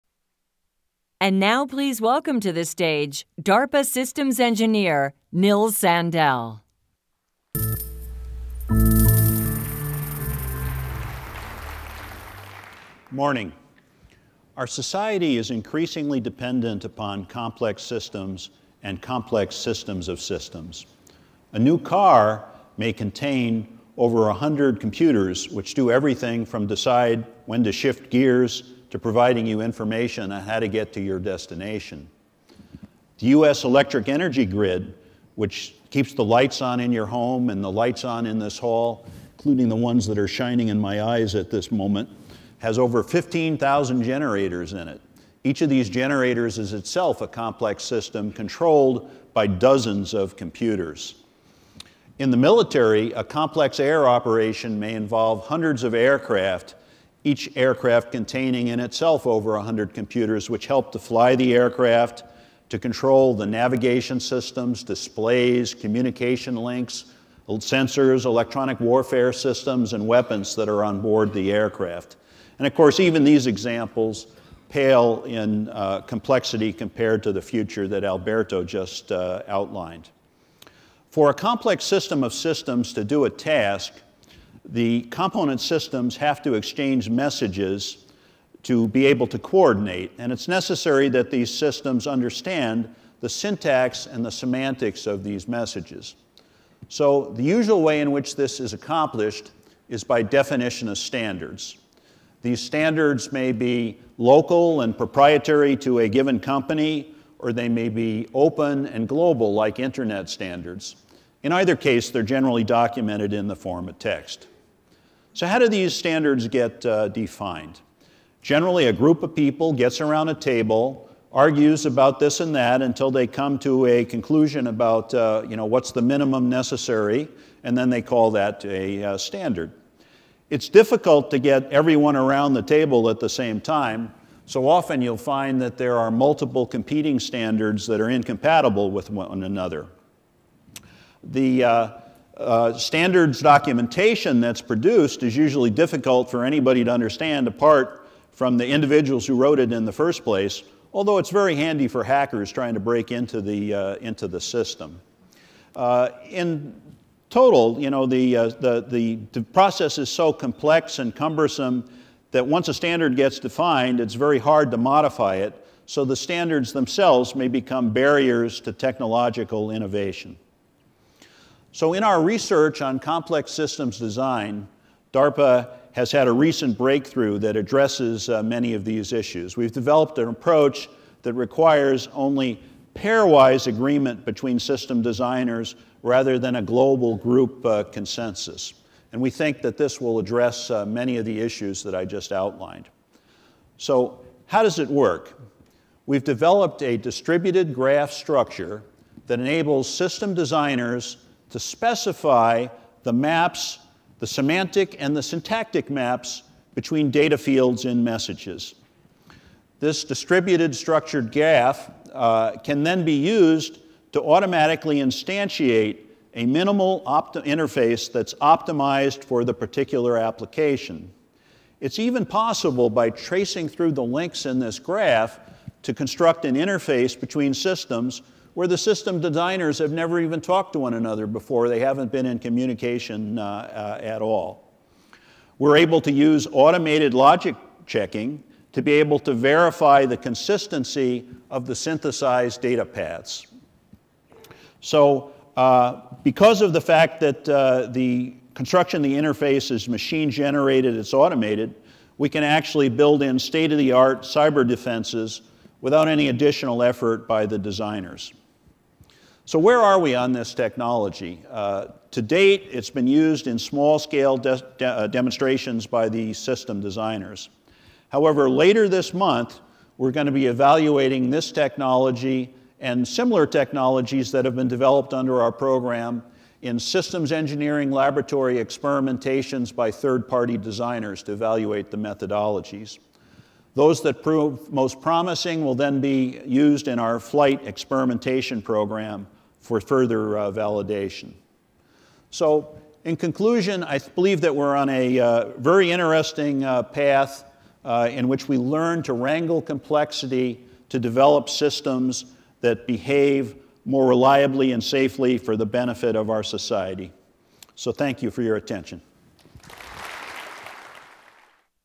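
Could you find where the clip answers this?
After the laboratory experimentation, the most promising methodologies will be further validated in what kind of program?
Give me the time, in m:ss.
4:47.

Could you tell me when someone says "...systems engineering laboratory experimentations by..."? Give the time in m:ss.
4:36.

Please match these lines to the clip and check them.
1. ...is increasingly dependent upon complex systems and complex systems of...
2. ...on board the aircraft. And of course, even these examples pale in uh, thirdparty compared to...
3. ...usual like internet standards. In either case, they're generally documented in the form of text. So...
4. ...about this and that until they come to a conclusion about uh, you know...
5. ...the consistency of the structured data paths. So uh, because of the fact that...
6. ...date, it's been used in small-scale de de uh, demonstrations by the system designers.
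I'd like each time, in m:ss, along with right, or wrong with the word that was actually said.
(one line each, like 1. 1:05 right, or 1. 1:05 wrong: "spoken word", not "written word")
1. 0:15 right
2. 1:10 wrong: "complexity", not "thirdparty"
3. 1:49 wrong: "global", not "usual"
4. 2:01 right
5. 4:00 wrong: "synthesized", not "structured"
6. 4:22 right.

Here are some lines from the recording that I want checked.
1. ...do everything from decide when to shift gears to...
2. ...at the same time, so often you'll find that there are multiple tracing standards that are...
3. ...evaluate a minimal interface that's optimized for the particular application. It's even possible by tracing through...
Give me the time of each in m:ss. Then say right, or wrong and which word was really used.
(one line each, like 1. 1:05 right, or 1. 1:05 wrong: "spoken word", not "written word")
1. 0:25 right
2. 2:13 wrong: "competing", not "tracing"
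3. 3:34 wrong: "instantiate", not "evaluate".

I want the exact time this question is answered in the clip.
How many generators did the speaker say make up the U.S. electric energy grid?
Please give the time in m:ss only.
0:42.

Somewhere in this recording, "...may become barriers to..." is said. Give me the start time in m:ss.
2:47.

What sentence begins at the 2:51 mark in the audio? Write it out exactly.
So, in our research on complex systems design, DARPA has had a recent breakthrough that addresses uh, many of these issues.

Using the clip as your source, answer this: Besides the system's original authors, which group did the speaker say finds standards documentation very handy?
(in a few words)
hackers.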